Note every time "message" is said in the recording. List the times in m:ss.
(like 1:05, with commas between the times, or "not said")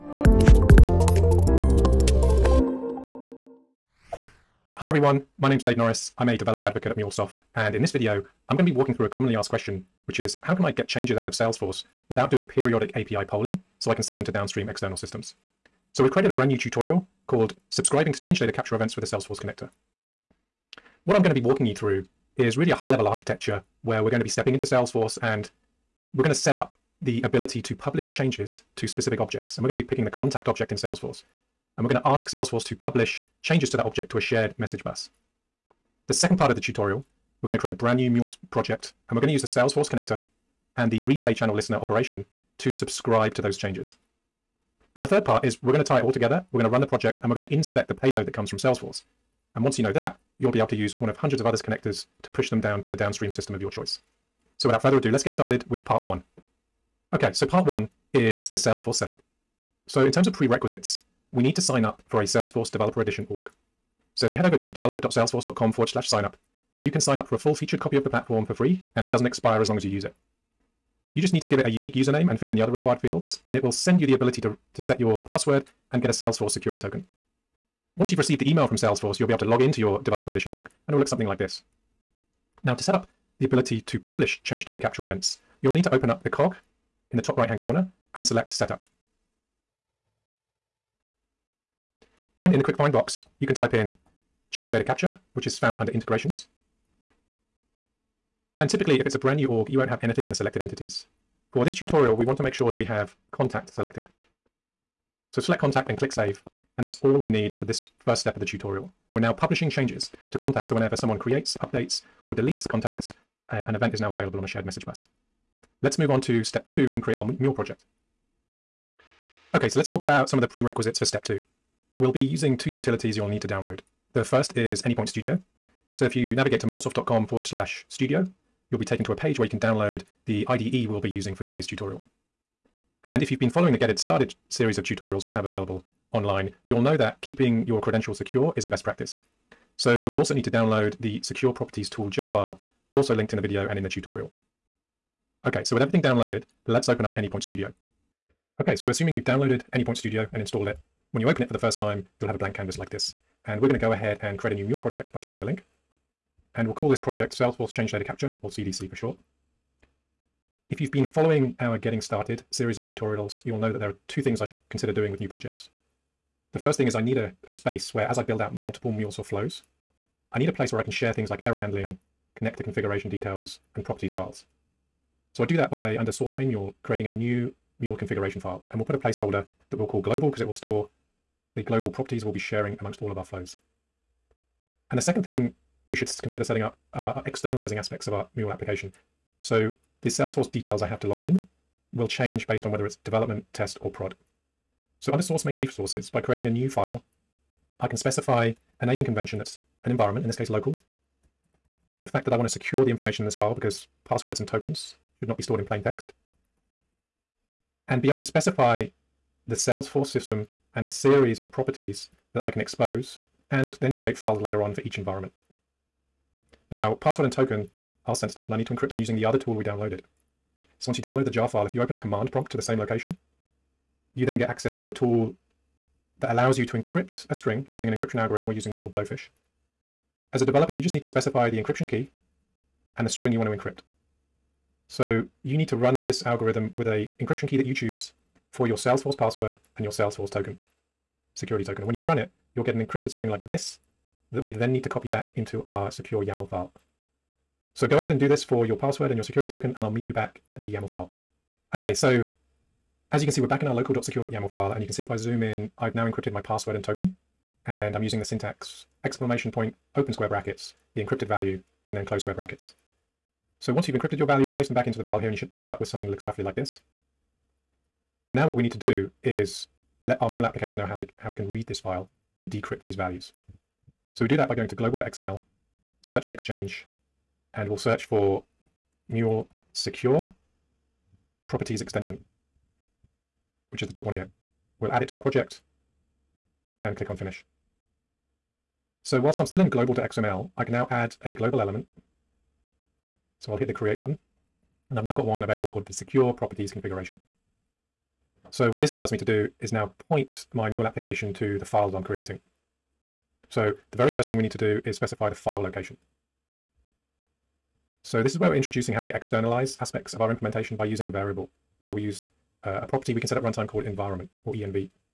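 0:34, 1:54.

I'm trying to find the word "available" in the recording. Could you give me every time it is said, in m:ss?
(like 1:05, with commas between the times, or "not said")
1:54, 2:15, 4:55.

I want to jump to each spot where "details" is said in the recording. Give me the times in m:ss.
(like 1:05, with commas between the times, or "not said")
2:53, 3:10.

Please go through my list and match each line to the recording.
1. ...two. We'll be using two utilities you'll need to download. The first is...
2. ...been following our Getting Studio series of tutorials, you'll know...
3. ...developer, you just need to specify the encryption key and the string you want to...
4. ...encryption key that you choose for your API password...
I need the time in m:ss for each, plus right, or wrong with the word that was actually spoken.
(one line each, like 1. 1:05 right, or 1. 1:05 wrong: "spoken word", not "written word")
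1. 2:01 right
2. 2:40 wrong: "Started", not "Studio"
3. 3:50 right
4. 3:57 wrong: "Salesforce", not "API".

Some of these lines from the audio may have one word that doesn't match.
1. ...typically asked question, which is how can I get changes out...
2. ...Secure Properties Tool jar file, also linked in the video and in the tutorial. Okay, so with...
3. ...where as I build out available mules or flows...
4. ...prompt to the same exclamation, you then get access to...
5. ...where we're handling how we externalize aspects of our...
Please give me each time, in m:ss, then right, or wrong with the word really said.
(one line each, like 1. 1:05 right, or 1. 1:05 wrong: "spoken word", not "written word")
1. 0:09 wrong: "commonly", not "typically"
2. 2:21 right
3. 2:47 wrong: "multiple", not "available"
4. 3:42 wrong: "location", not "exclamation"
5. 5:08 wrong: "introducing", not "handling".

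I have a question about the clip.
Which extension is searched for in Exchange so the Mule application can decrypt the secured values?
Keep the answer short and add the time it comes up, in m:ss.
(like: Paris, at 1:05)
Mule Secure Properties Extension, at 4:39.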